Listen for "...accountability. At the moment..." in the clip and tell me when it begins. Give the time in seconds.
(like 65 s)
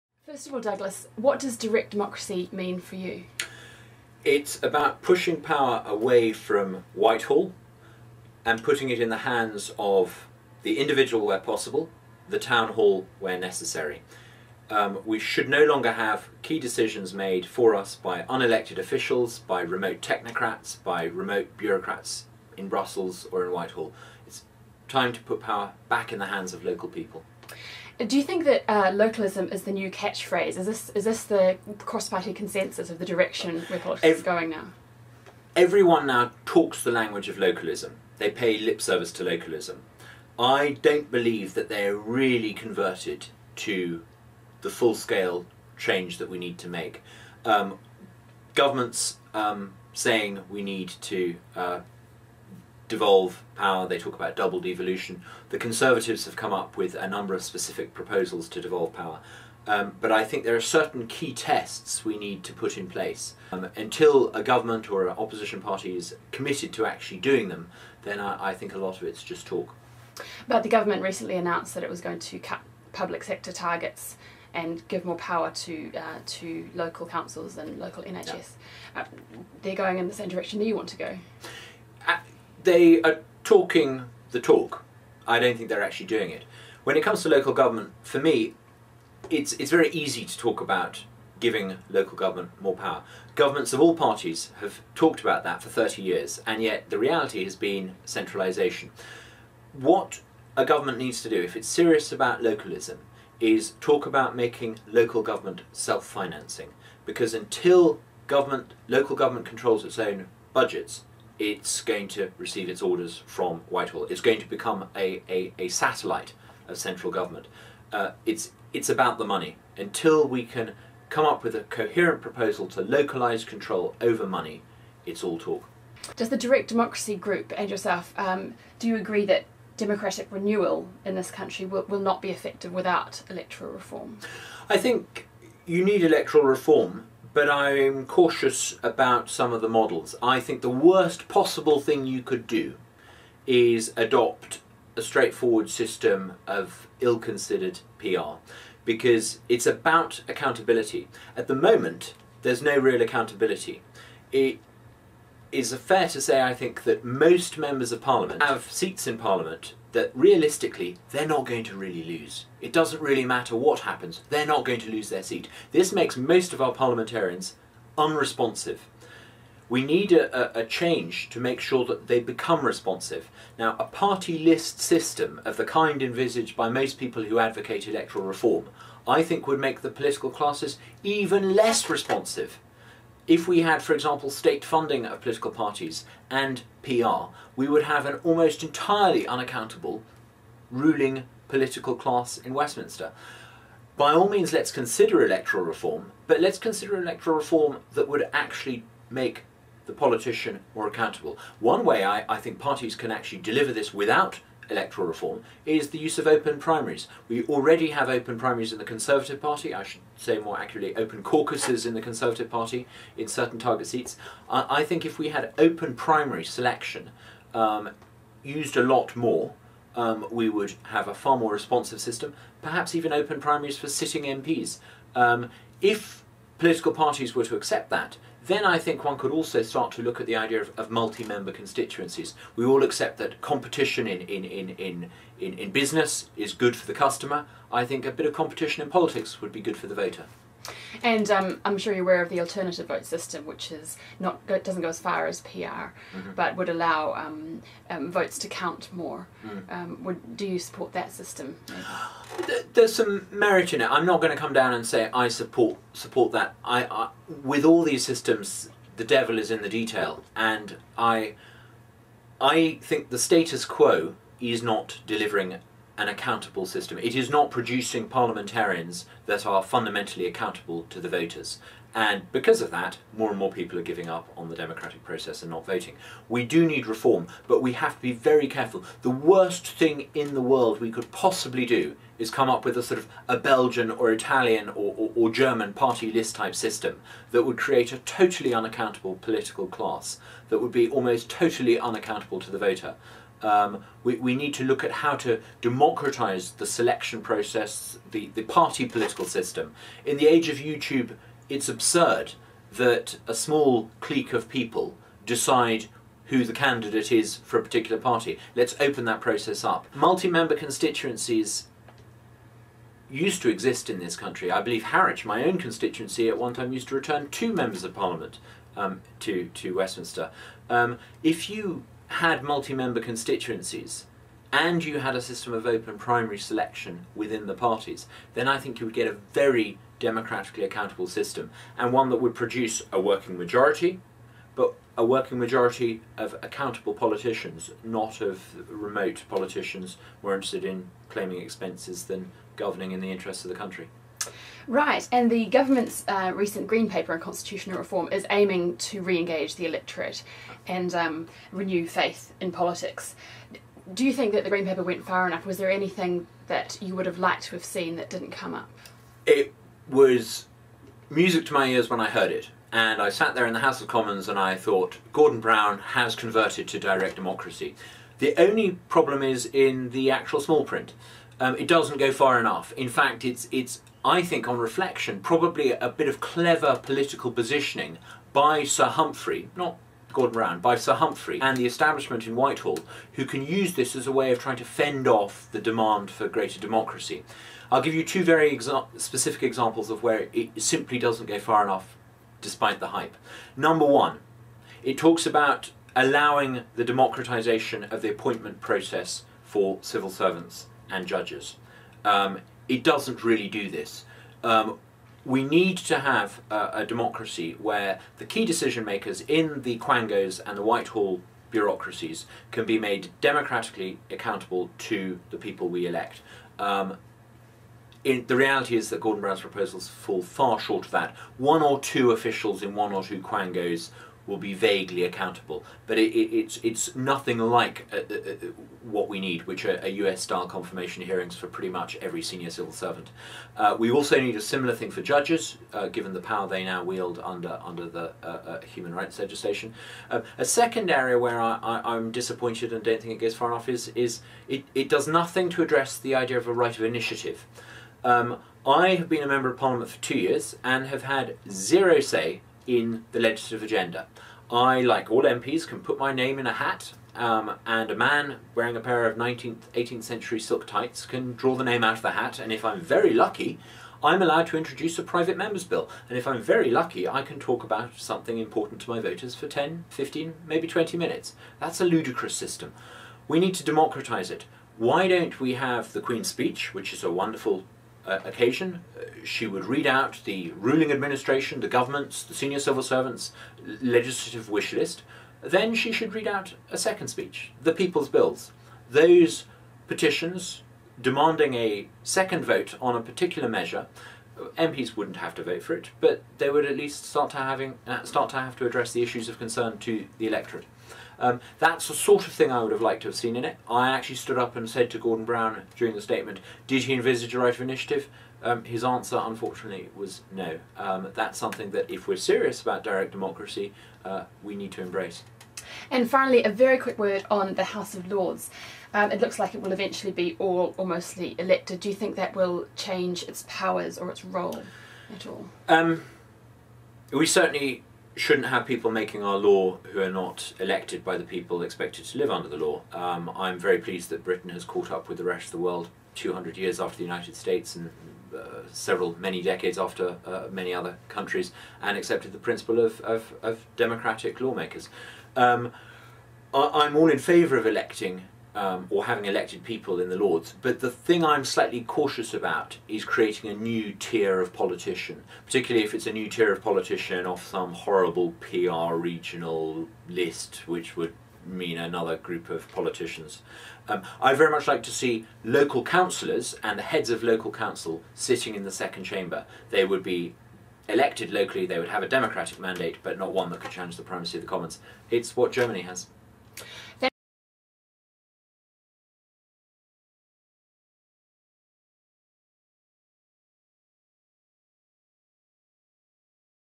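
150 s.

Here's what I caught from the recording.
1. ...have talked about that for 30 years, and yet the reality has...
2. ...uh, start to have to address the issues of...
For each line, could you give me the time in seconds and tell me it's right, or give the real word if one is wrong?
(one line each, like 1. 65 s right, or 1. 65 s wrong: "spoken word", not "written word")
1. 94 s right
2. 497 s right.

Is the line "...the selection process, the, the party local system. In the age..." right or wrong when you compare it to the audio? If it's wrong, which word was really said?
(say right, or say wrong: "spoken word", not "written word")
wrong: "political", not "local".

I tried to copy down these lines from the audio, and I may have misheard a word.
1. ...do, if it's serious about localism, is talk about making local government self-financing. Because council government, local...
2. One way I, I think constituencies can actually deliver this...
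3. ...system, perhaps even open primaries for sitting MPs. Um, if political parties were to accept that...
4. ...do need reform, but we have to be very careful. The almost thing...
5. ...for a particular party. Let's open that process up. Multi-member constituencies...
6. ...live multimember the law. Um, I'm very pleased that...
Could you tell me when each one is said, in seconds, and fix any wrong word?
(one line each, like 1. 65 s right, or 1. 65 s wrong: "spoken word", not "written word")
1. 101 s wrong: "until", not "council"
2. 201 s wrong: "parties", not "constituencies"
3. 221 s right
4. 276 s wrong: "worst", not "almost"
5. 307 s right
6. 532 s wrong: "under", not "multimember".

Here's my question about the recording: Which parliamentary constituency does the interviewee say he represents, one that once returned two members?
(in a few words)
Harwich.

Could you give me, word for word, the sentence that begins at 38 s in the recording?
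They pay lip service to localism.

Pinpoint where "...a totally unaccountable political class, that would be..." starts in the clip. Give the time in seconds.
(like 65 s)
287 s.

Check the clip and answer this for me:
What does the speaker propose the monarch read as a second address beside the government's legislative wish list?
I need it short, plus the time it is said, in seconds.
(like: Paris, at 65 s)
The people's bills, at 487 s.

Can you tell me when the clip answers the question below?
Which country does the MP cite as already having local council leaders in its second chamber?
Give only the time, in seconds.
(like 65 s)
575 s.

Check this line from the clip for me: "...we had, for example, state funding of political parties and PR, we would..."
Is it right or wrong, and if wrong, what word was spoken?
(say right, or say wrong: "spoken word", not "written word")
right.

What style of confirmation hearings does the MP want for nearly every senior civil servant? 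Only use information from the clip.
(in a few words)
U.S.-style.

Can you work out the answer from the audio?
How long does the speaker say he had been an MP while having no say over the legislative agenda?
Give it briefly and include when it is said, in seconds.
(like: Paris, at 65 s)
Two years, at 450 s.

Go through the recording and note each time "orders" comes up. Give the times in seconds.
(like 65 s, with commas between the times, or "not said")
112 s.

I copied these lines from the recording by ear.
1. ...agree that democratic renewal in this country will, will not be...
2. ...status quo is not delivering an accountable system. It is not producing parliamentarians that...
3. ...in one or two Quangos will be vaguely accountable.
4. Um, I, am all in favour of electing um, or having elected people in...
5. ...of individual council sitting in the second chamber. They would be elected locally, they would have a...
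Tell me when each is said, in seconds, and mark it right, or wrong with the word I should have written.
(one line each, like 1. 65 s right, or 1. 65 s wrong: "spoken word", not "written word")
1. 128 s right
2. 263 s right
3. 422 s right
4. 545 s right
5. 567 s wrong: "local", not "individual".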